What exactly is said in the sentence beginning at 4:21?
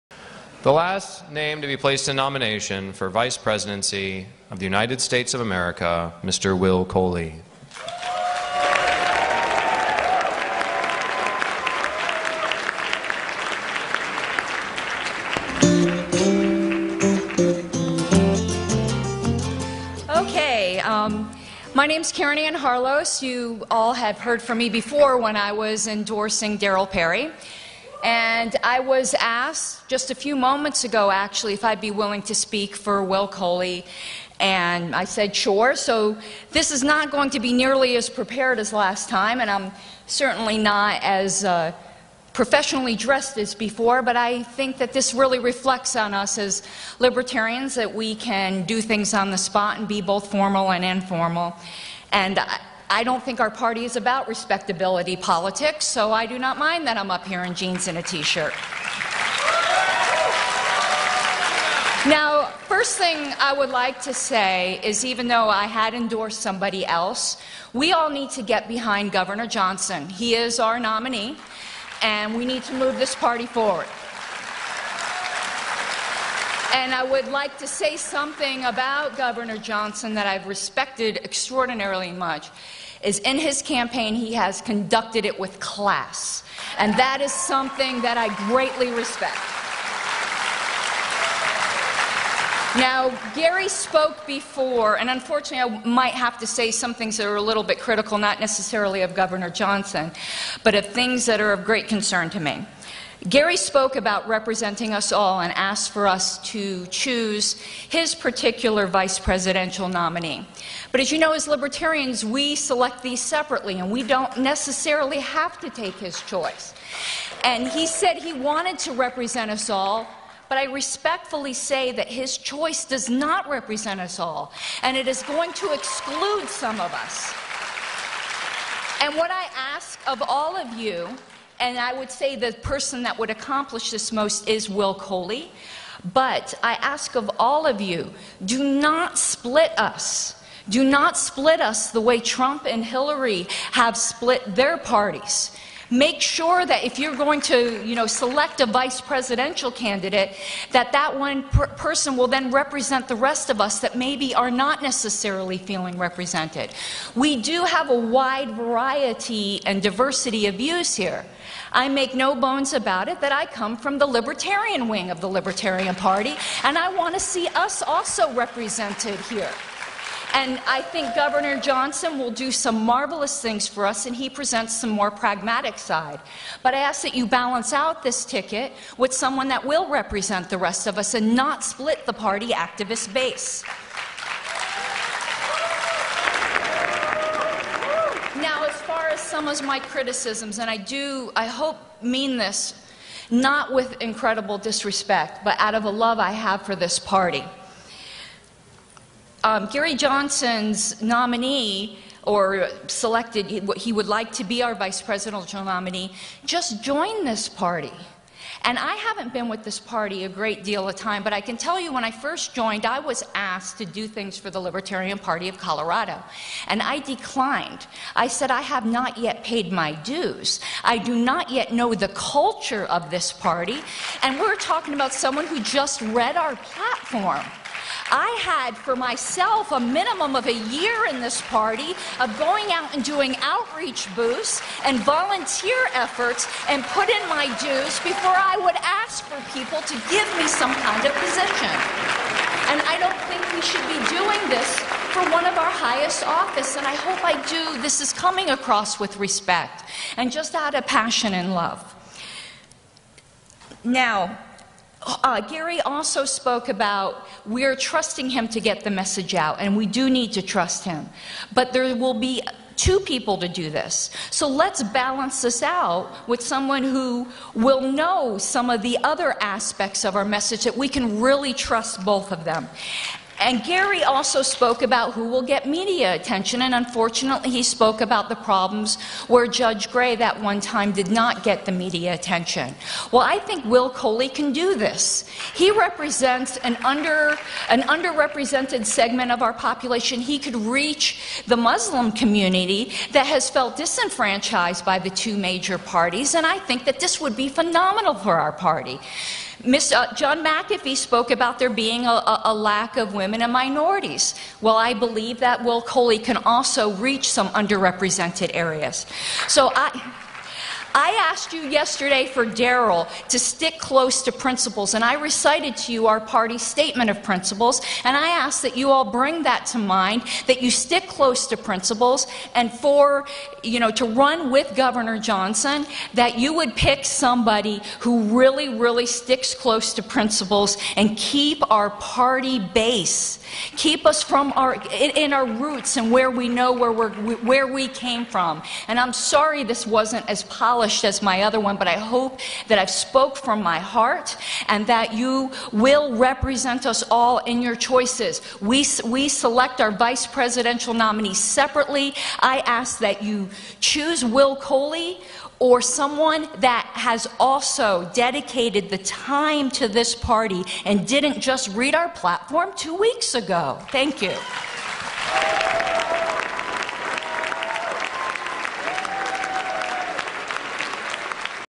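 But there will be two people to do this.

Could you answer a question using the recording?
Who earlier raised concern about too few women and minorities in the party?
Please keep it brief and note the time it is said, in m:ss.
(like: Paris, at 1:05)
John McAfee, at 5:00.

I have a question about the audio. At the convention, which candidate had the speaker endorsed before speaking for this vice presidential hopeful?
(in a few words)
Darryl Perry.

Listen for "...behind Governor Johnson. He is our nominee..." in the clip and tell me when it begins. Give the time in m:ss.
1:08.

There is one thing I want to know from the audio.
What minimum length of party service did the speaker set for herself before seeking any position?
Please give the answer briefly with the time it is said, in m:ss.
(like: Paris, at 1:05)
a year, at 3:50.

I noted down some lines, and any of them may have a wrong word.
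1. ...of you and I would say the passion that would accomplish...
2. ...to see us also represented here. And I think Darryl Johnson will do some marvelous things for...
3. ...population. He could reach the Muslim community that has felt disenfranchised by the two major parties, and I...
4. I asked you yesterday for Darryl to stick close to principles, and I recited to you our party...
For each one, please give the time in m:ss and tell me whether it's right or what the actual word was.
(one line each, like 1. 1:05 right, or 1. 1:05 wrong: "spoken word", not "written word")
1. 2:10 wrong: "person", not "passion"
2. 2:47 wrong: "Governor", not "Darryl"
3. 4:49 right
4. 5:10 right.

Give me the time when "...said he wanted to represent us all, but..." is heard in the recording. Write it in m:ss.
1:57.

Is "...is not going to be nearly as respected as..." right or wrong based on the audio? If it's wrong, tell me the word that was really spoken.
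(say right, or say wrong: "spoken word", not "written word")
wrong: "prepared", not "respected".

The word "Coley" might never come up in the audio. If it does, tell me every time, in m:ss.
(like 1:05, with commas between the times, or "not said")
0:06, 0:33, 2:14, 4:43, 5:05, 5:54.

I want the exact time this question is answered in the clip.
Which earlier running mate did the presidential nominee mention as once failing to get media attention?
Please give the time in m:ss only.
4:39.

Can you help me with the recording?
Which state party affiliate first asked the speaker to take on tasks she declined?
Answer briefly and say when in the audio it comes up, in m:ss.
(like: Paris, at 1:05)
Colorado, at 3:35.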